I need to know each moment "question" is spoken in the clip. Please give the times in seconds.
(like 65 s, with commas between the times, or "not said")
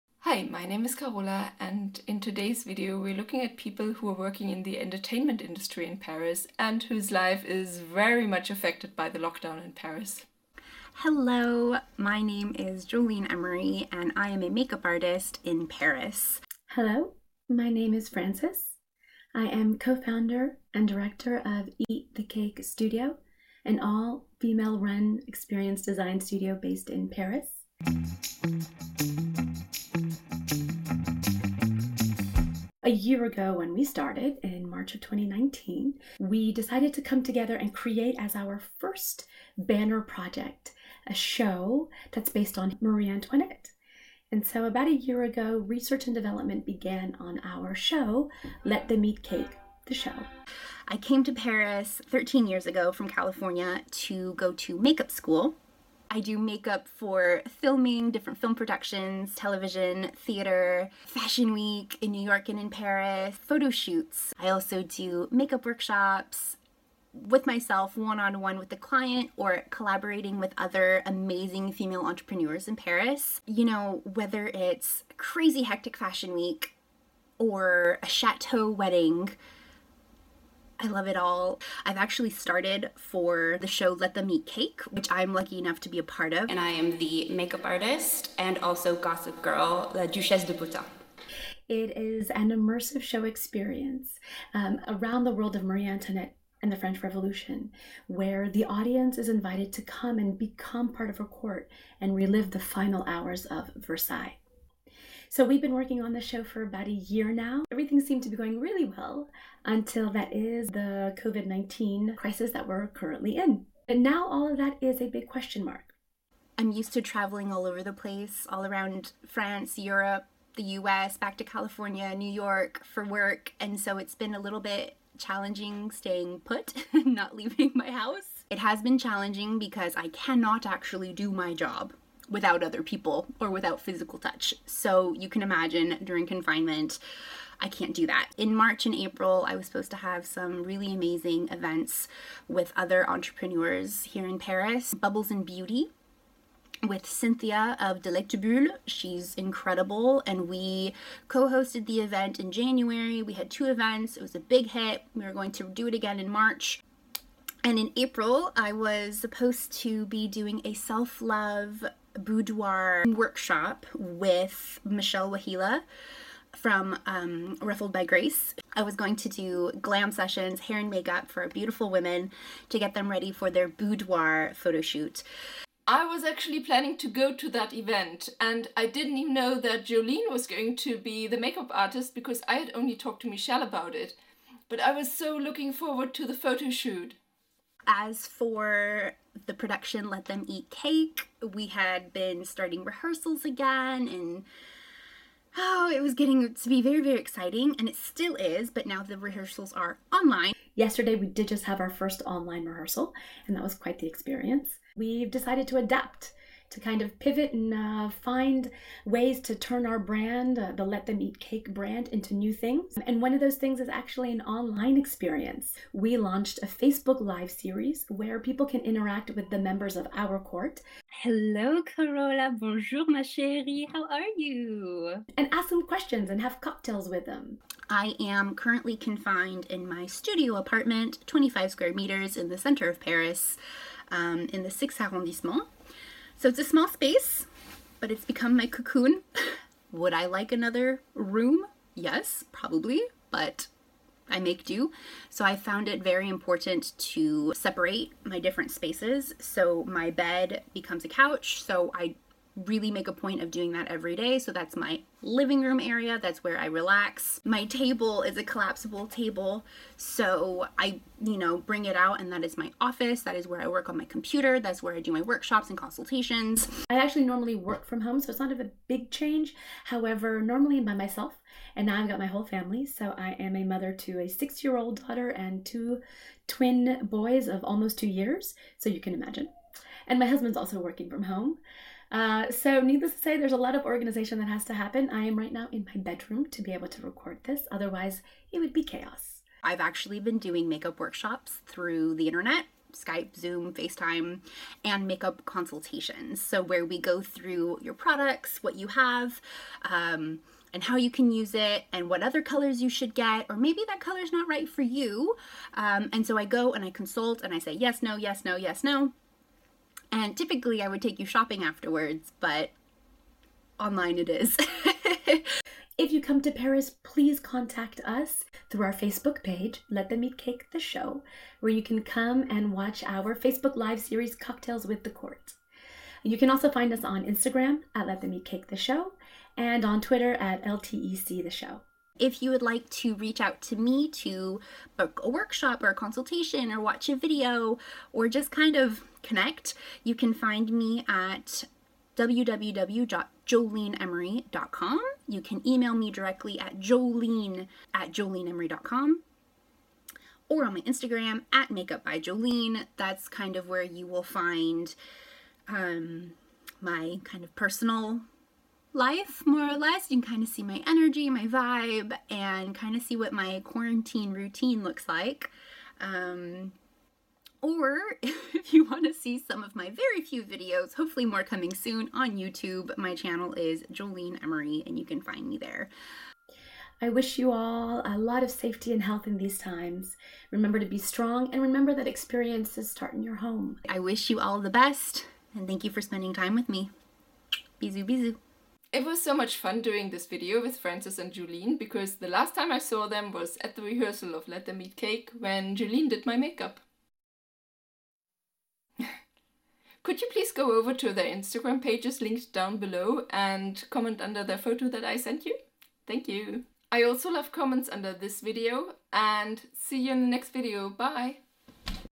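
115 s, 225 s.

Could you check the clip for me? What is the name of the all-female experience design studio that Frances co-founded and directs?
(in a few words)
Eat the Cake Studio.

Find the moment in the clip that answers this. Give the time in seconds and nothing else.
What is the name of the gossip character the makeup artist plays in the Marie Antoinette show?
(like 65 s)
89 s.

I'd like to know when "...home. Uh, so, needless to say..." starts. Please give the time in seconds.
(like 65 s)
281 s.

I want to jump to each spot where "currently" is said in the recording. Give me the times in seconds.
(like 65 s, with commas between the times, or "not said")
112 s, 228 s.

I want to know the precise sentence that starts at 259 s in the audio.
So I, you know, bring it out and that is my office.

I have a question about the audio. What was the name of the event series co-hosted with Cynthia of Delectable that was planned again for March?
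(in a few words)
Bubbles and Beauty.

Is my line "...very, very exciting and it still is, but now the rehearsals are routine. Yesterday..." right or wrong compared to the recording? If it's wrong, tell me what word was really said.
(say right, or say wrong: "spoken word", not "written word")
wrong: "online", not "routine".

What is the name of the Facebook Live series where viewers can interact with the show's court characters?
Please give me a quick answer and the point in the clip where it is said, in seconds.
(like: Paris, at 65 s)
Cocktails with the Court, at 324 s.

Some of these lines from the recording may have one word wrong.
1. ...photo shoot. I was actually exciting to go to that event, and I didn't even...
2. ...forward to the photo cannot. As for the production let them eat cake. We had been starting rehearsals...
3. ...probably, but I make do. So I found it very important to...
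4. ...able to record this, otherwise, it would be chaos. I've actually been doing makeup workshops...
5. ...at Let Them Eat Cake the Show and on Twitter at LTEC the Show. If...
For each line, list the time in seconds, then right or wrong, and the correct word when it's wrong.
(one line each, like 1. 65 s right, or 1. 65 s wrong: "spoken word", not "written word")
1. 174 s wrong: "planning", not "exciting"
2. 185 s wrong: "shoot", not "cannot"
3. 242 s right
4. 286 s right
5. 327 s right.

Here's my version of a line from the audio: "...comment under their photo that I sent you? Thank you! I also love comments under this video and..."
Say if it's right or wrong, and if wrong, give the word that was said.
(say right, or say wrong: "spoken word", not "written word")
right.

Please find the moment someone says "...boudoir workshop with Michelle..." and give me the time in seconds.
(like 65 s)
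162 s.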